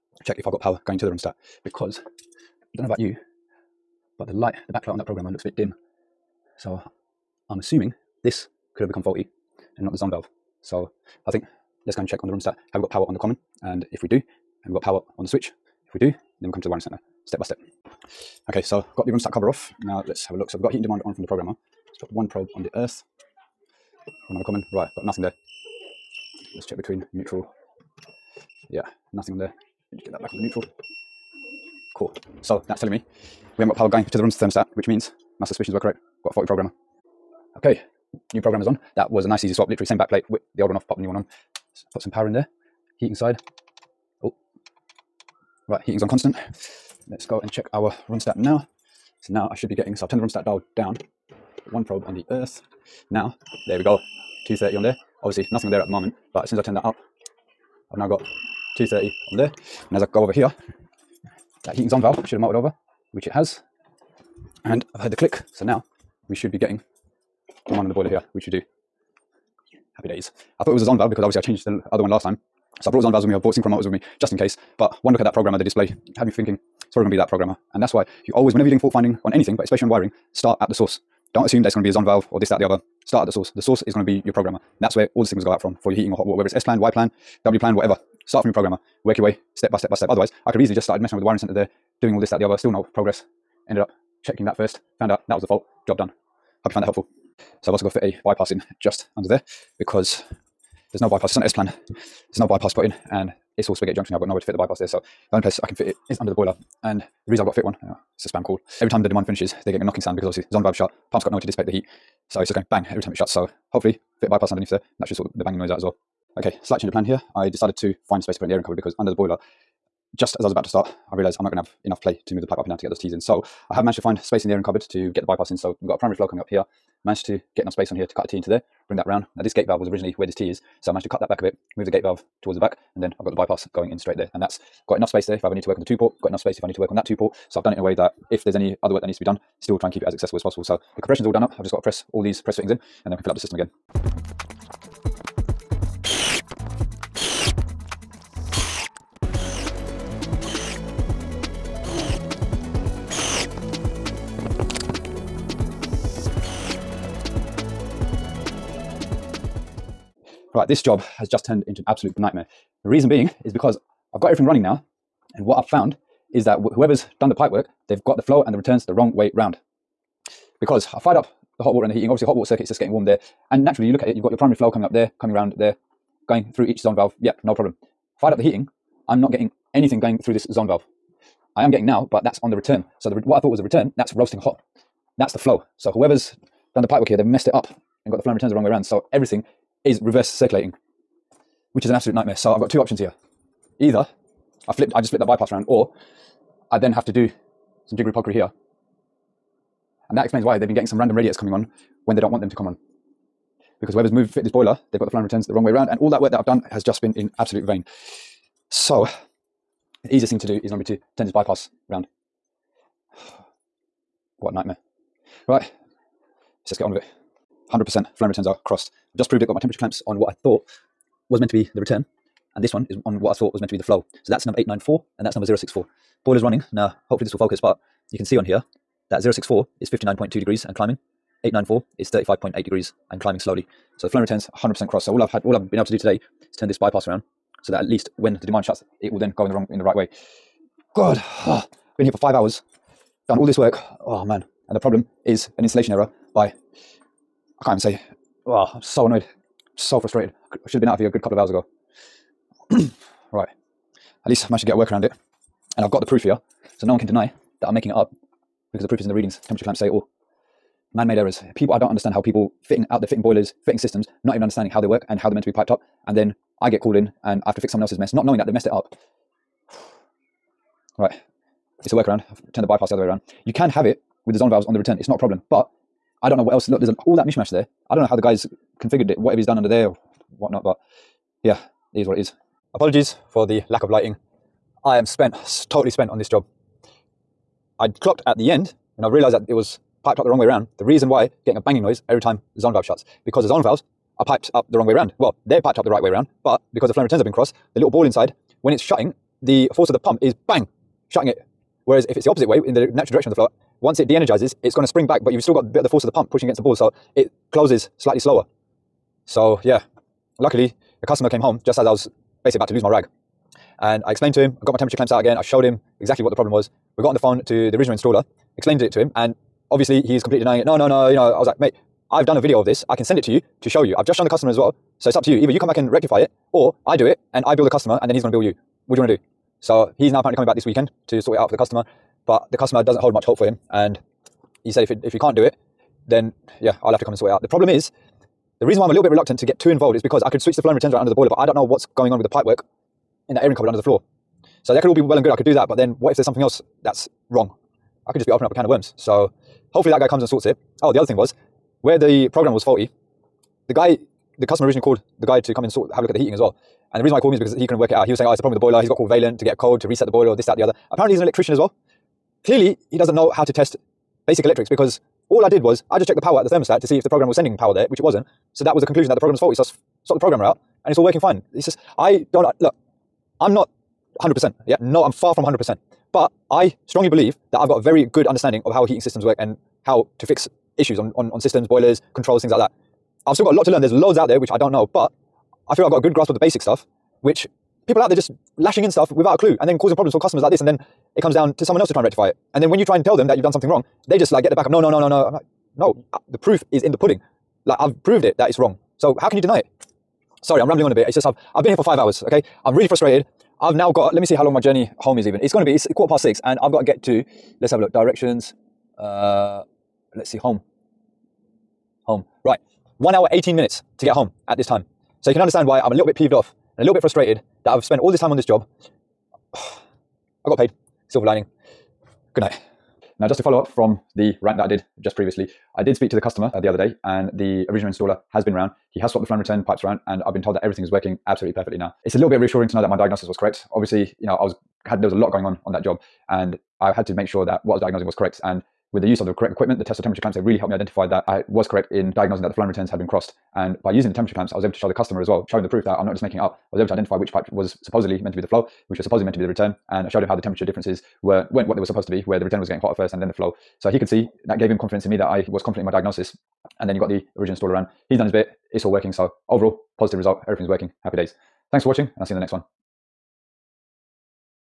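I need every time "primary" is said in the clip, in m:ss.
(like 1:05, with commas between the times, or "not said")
2:05, 2:54.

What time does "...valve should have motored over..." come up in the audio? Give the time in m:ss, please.
1:02.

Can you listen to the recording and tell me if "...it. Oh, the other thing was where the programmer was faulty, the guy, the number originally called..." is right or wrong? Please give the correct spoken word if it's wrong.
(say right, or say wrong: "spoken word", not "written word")
wrong: "customer", not "number".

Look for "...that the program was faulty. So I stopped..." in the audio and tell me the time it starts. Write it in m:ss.
6:09.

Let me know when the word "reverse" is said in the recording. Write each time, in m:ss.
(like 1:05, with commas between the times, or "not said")
3:10.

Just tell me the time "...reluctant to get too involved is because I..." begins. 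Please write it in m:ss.
5:39.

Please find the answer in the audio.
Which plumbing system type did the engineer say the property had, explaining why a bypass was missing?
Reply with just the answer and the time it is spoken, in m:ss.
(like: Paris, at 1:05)
S-plan, at 1:41.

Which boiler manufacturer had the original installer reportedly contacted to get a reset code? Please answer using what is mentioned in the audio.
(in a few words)
Vaillant.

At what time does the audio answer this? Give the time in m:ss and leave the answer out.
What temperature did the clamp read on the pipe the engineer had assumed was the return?
3:49.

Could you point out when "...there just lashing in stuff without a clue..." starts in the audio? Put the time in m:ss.
6:28.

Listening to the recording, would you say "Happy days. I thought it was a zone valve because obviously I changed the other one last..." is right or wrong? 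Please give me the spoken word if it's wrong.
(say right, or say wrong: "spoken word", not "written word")
right.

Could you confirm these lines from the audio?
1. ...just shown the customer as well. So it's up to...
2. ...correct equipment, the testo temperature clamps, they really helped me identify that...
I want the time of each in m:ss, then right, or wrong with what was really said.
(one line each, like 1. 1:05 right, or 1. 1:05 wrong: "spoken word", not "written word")
1. 5:24 right
2. 7:19 right.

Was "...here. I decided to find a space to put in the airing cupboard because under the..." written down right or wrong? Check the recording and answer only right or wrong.
right.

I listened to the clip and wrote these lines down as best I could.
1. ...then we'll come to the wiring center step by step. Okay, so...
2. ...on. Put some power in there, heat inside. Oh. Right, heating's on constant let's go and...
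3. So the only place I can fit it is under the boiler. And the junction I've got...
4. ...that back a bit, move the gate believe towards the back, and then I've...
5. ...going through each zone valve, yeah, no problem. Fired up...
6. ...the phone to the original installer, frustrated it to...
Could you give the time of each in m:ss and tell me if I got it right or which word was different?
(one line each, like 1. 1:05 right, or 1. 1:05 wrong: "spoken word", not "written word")
1. 0:16 right
2. 0:41 right
3. 1:44 wrong: "reason", not "junction"
4. 2:11 wrong: "valve", not "believe"
5. 2:56 right
6. 5:17 wrong: "explained", not "frustrated".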